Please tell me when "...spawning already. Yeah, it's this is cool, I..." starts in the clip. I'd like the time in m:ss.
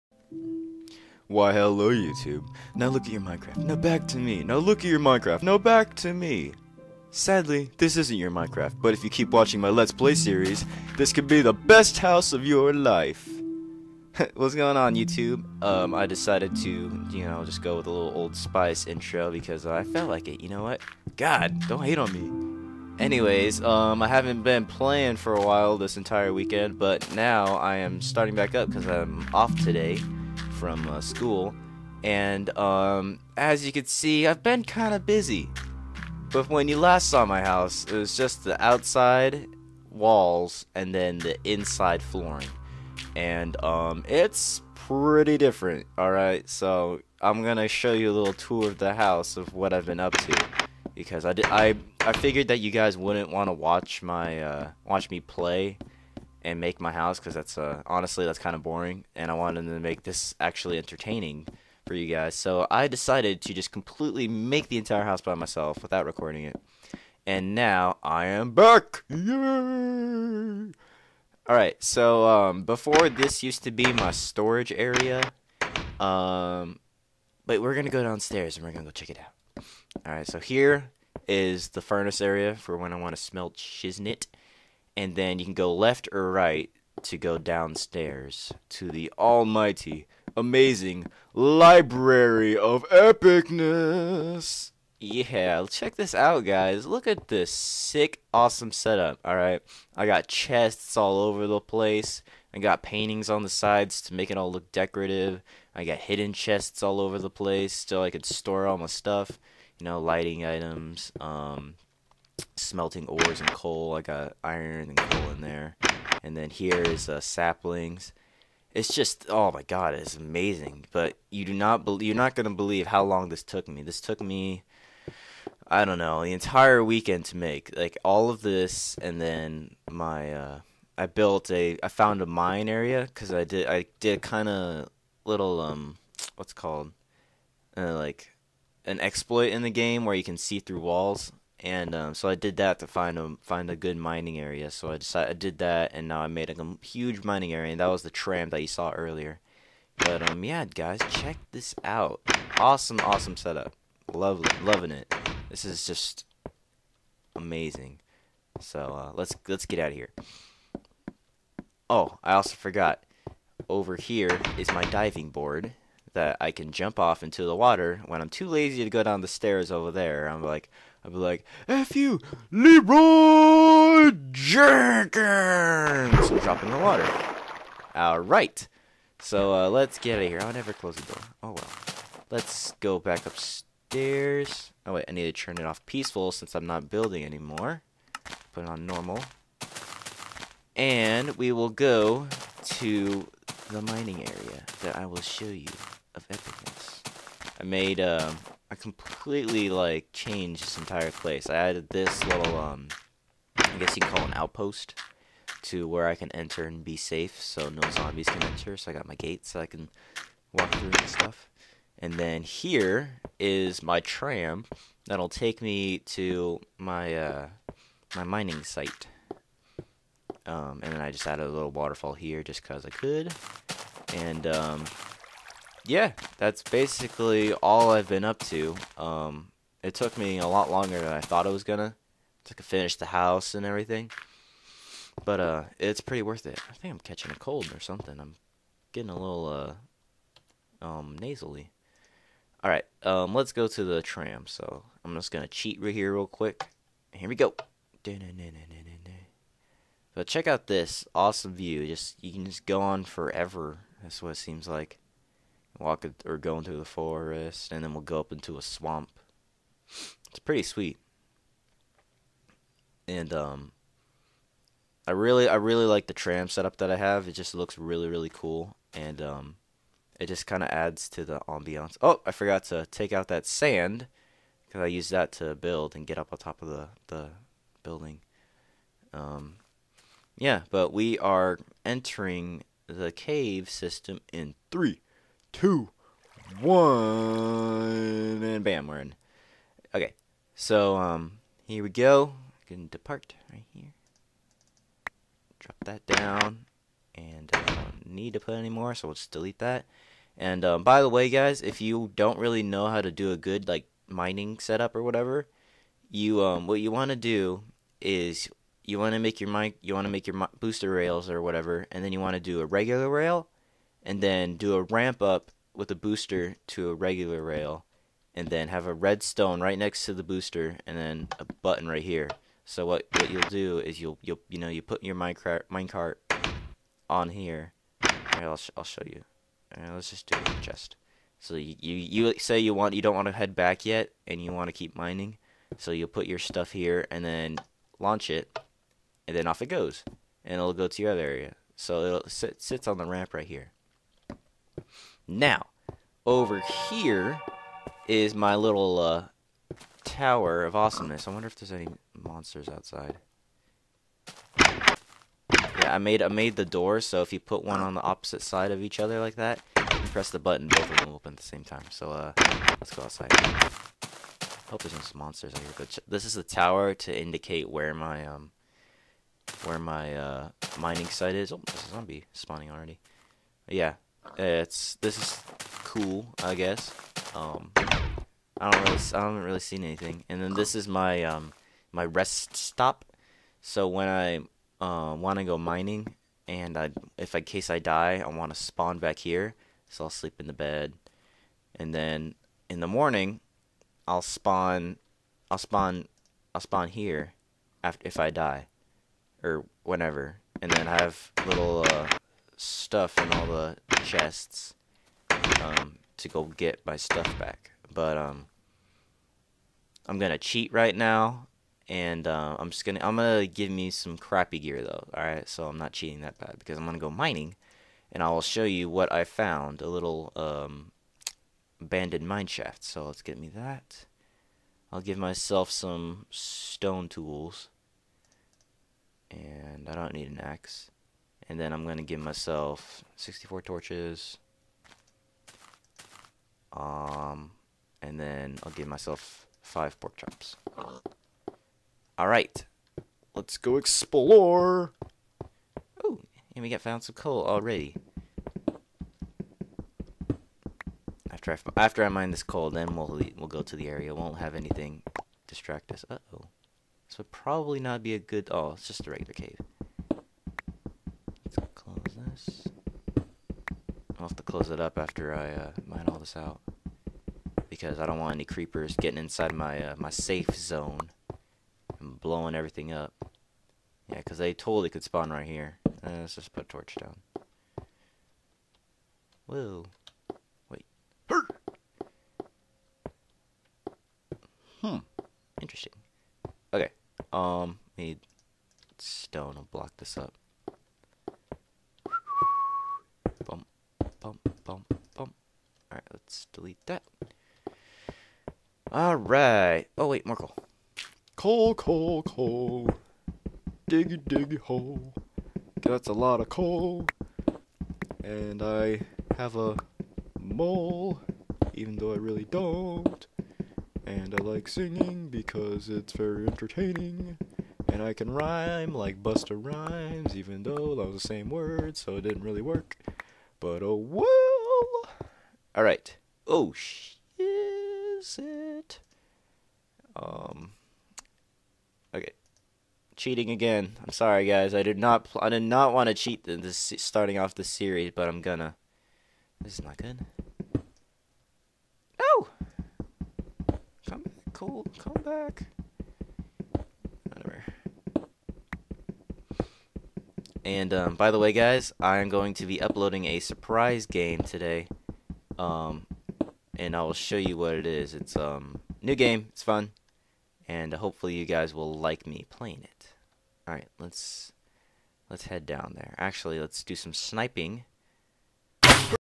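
6:12.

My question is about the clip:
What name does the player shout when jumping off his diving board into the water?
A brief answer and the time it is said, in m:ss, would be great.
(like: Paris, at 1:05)
Leroy Jenkins, at 2:52.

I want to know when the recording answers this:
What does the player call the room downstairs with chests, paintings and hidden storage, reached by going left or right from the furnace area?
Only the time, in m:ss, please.
1:31.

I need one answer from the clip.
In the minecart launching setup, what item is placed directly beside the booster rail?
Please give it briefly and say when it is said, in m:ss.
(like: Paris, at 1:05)
redstone, at 5:18.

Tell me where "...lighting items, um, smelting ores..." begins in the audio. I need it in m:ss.
1:49.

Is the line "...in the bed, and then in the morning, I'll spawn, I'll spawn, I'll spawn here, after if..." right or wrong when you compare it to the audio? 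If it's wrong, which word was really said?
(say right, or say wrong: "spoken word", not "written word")
right.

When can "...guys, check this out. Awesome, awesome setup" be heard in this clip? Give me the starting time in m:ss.
2:30.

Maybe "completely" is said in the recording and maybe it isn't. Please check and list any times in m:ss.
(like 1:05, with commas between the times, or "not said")
1:03, 3:18.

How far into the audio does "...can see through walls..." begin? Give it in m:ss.
2:20.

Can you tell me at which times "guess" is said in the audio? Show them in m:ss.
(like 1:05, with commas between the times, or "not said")
3:23, 6:16.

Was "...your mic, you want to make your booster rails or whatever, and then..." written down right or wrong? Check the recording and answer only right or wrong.
right.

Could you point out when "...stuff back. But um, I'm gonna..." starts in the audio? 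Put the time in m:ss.
6:46.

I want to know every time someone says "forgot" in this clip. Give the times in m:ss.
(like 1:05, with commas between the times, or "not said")
2:42, 4:32.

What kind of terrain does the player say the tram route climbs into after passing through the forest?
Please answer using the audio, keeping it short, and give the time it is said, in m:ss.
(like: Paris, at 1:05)
swamp, at 4:18.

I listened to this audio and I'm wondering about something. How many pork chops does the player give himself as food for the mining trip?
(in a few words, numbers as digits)
5.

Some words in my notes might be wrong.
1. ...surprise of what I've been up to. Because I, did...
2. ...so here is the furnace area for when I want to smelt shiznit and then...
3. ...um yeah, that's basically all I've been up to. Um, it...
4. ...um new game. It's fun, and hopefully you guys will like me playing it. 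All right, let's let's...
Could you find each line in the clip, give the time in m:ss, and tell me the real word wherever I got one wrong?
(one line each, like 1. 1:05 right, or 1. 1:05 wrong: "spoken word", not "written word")
1. 0:48 wrong: "house", not "surprise"
2. 1:20 right
3. 3:44 right
4. 9:18 right.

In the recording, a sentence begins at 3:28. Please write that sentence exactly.
So I got my gate so I can walk through and stuff.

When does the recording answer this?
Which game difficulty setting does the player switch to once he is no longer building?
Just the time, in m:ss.
3:08.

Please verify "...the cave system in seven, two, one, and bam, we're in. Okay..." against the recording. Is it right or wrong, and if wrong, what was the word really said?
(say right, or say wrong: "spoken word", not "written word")
wrong: "three", not "seven".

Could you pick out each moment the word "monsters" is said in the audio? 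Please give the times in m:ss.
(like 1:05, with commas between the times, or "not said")
5:52, 6:05.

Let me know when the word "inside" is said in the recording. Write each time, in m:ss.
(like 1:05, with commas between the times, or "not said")
0:41, 7:49.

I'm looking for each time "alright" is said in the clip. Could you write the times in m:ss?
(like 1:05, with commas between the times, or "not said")
0:45, 2:57, 7:22, 8:45.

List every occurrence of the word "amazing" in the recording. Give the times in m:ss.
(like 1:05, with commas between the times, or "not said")
1:30, 2:00, 2:37.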